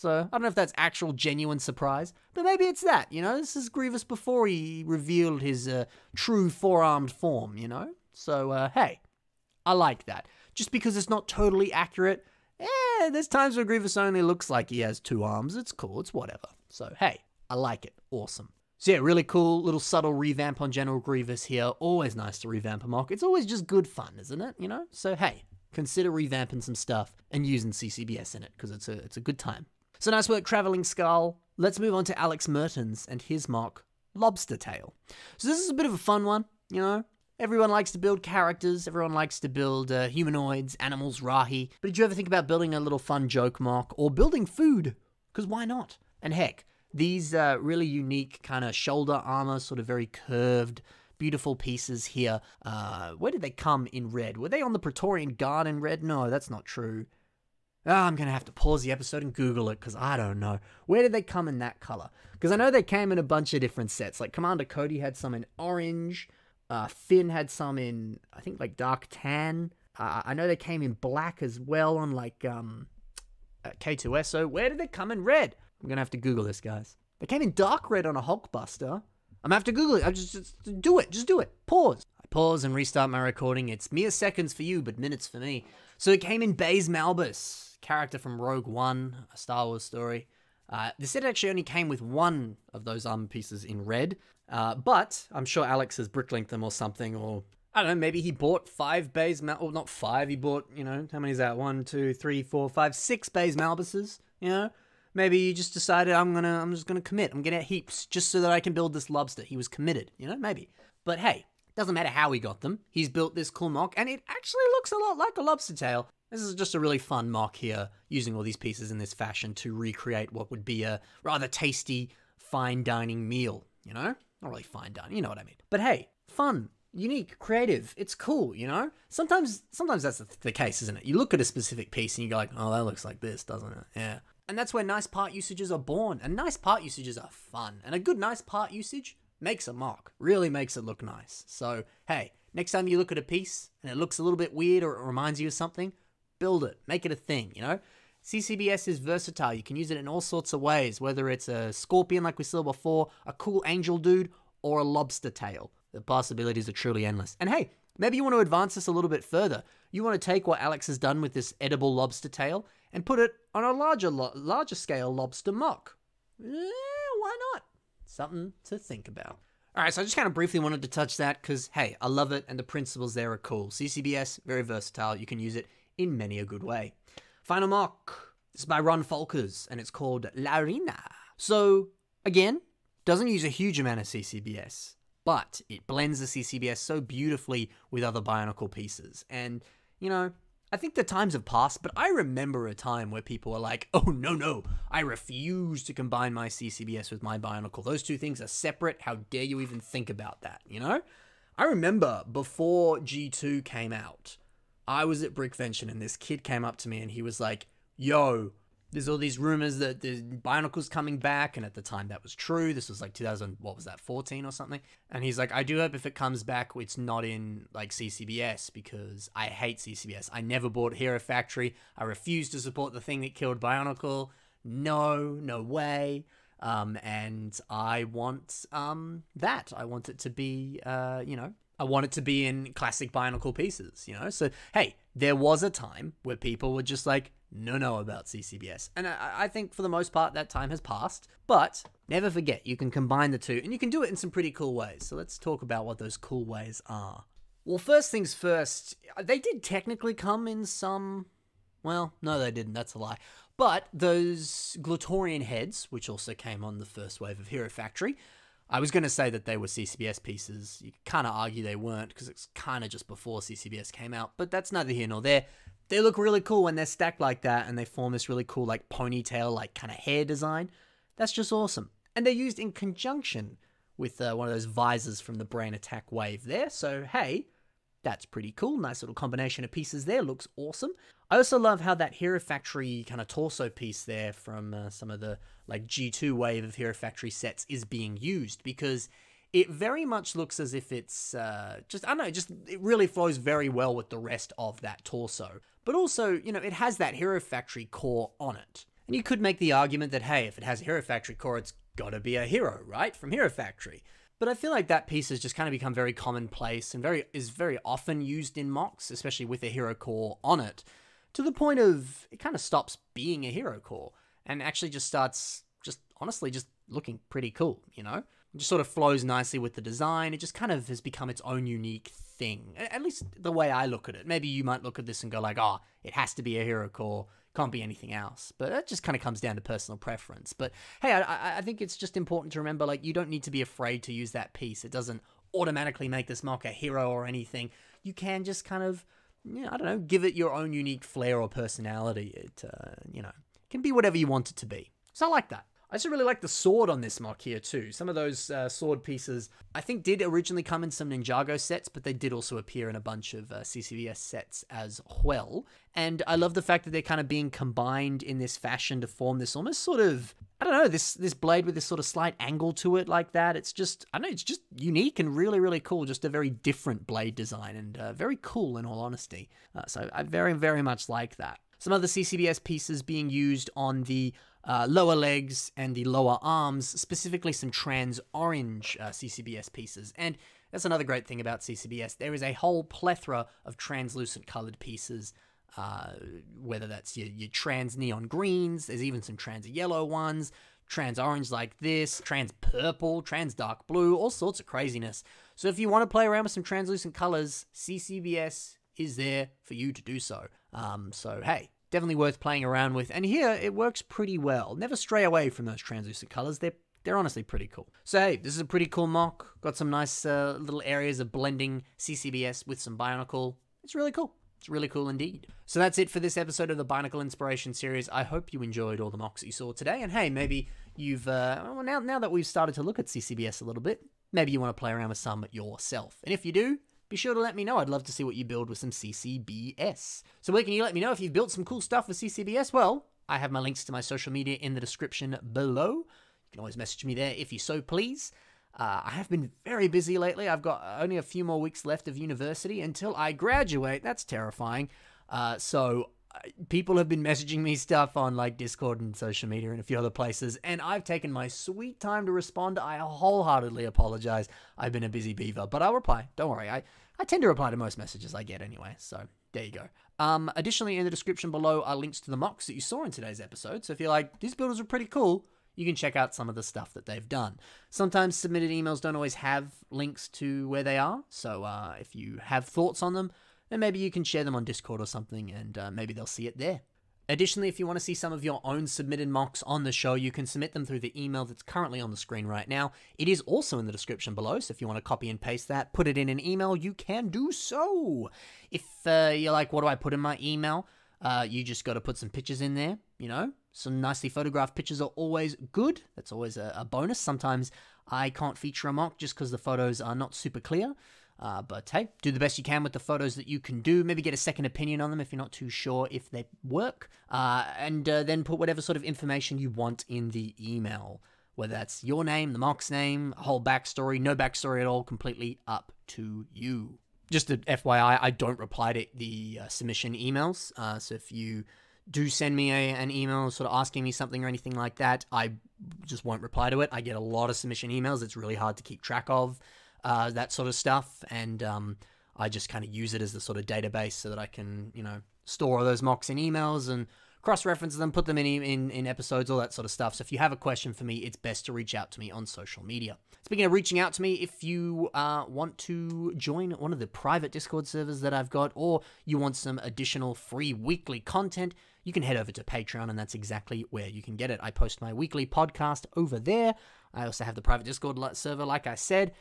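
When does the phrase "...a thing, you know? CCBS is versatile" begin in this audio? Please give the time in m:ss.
2:27.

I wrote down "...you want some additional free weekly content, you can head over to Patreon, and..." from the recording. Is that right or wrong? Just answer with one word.
right.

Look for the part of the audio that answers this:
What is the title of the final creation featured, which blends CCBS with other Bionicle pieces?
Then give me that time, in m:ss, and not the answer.
3:00.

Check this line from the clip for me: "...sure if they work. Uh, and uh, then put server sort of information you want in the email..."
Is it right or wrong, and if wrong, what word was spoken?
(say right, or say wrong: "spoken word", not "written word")
wrong: "whatever", not "server".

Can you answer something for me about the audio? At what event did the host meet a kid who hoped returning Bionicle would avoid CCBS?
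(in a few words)
Brickvention.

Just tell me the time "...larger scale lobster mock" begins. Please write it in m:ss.
2:44.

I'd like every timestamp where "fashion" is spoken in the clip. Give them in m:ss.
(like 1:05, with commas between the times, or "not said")
1:59, 5:58.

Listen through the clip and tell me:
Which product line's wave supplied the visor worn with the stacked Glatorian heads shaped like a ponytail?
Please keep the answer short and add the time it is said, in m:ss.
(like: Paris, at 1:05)
Brain Attack, at 4:35.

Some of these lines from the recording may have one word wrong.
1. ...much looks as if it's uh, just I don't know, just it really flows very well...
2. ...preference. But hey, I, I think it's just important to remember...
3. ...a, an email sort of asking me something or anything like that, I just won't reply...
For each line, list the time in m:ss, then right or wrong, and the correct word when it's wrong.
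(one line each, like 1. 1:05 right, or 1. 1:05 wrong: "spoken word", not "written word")
1. 4:50 right
2. 5:29 right
3. 8:42 right.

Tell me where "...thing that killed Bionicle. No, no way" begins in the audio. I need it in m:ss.
3:43.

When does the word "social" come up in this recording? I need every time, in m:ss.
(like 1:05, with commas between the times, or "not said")
7:14, 7:29, 9:02.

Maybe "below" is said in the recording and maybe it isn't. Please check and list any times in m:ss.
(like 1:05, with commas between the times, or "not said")
7:15, 7:41, 8:04.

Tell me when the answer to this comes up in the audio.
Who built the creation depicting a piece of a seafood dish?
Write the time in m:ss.
0:32.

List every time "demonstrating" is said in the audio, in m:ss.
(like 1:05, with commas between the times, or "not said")
not said.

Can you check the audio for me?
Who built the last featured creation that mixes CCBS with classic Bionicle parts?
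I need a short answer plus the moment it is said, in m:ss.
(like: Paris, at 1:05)
Ron Folkers, at 2:58.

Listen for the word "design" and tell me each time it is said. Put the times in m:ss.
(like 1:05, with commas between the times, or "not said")
4:30, 5:19, 6:07.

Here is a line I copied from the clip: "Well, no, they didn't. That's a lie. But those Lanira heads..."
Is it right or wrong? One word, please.
wrong.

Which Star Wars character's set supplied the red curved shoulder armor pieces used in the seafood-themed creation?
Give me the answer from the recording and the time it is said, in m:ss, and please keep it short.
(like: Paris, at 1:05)
Baze Malbus, at 1:26.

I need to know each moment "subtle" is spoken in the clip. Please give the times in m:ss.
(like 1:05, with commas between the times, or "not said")
0:19.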